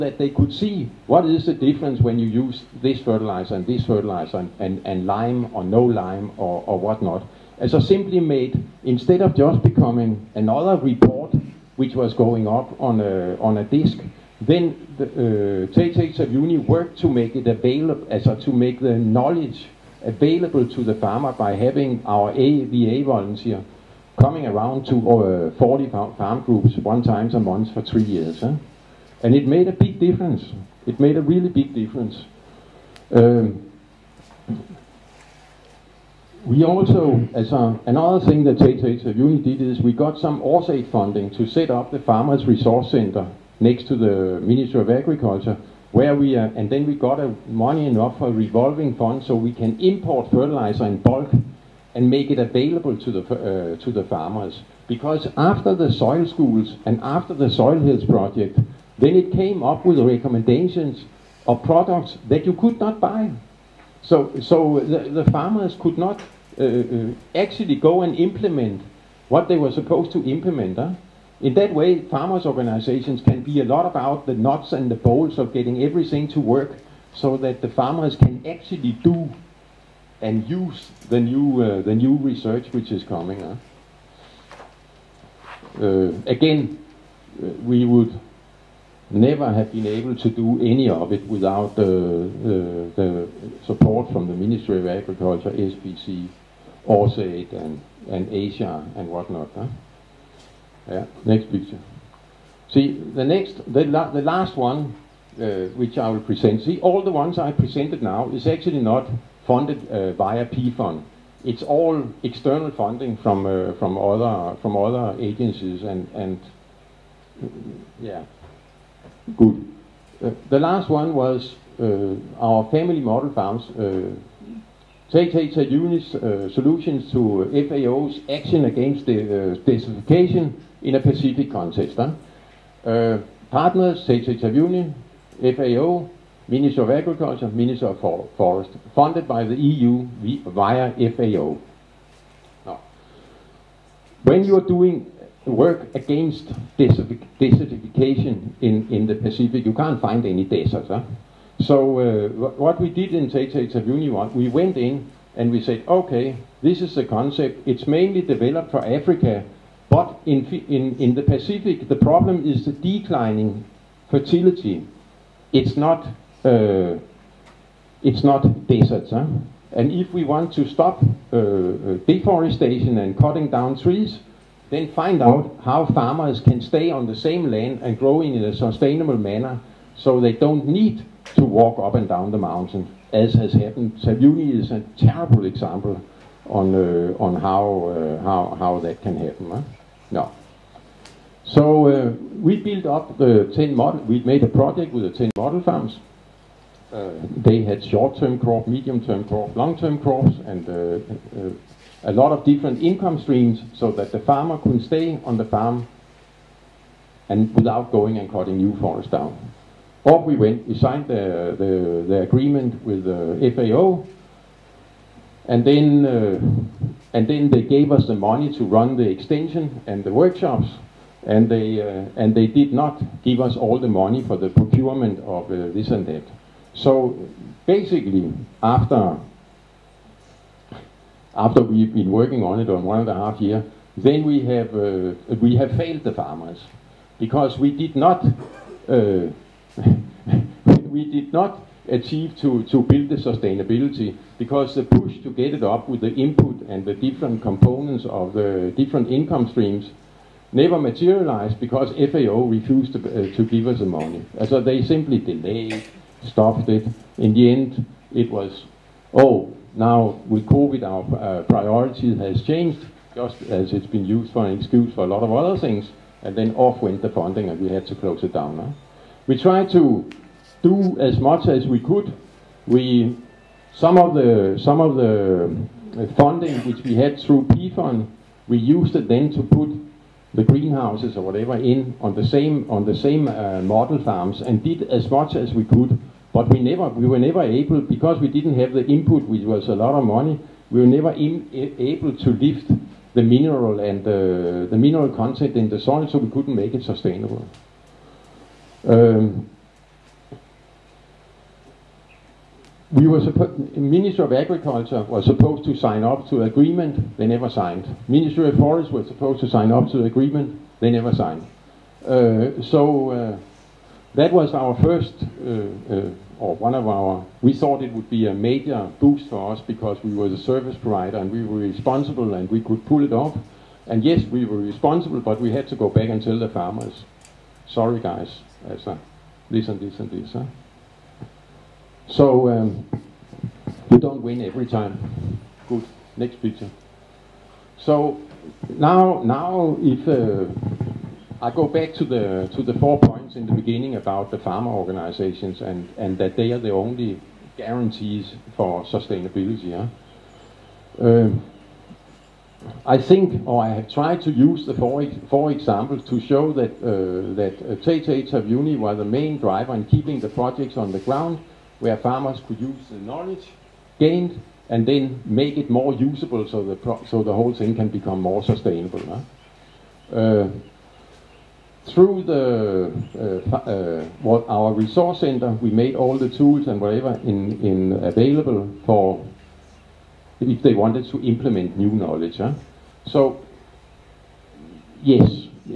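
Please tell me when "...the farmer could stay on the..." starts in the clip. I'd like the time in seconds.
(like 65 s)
204 s.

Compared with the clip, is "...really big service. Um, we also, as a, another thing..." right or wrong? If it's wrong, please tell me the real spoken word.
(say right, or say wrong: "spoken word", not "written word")
wrong: "difference", not "service".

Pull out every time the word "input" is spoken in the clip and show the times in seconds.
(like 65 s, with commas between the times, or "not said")
246 s, 288 s.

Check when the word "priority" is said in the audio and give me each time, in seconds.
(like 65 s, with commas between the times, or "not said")
261 s.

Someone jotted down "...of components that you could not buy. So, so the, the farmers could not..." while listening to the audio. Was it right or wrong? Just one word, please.
wrong.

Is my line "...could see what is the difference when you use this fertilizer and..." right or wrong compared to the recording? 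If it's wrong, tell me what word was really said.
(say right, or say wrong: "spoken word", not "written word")
right.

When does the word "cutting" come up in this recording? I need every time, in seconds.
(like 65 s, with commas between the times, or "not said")
173 s, 208 s.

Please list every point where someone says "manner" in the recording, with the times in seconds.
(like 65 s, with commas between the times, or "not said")
179 s.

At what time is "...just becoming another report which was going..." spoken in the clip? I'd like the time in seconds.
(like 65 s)
9 s.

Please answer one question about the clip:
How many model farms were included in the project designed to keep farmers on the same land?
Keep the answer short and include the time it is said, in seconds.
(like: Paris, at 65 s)
10, at 195 s.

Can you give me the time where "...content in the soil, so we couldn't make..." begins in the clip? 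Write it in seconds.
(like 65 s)
295 s.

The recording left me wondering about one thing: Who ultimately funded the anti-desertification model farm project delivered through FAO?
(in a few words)
the EU.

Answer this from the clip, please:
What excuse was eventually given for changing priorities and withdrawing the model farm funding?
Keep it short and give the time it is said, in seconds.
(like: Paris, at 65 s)
COVID, at 260 s.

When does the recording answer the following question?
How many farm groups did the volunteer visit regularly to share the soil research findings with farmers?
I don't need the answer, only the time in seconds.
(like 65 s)
25 s.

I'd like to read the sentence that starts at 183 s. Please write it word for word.
Taveuni is a terrible example on uh, on how uh, how how that can happen.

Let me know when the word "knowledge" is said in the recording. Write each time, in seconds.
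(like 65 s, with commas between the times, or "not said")
18 s, 362 s, 381 s.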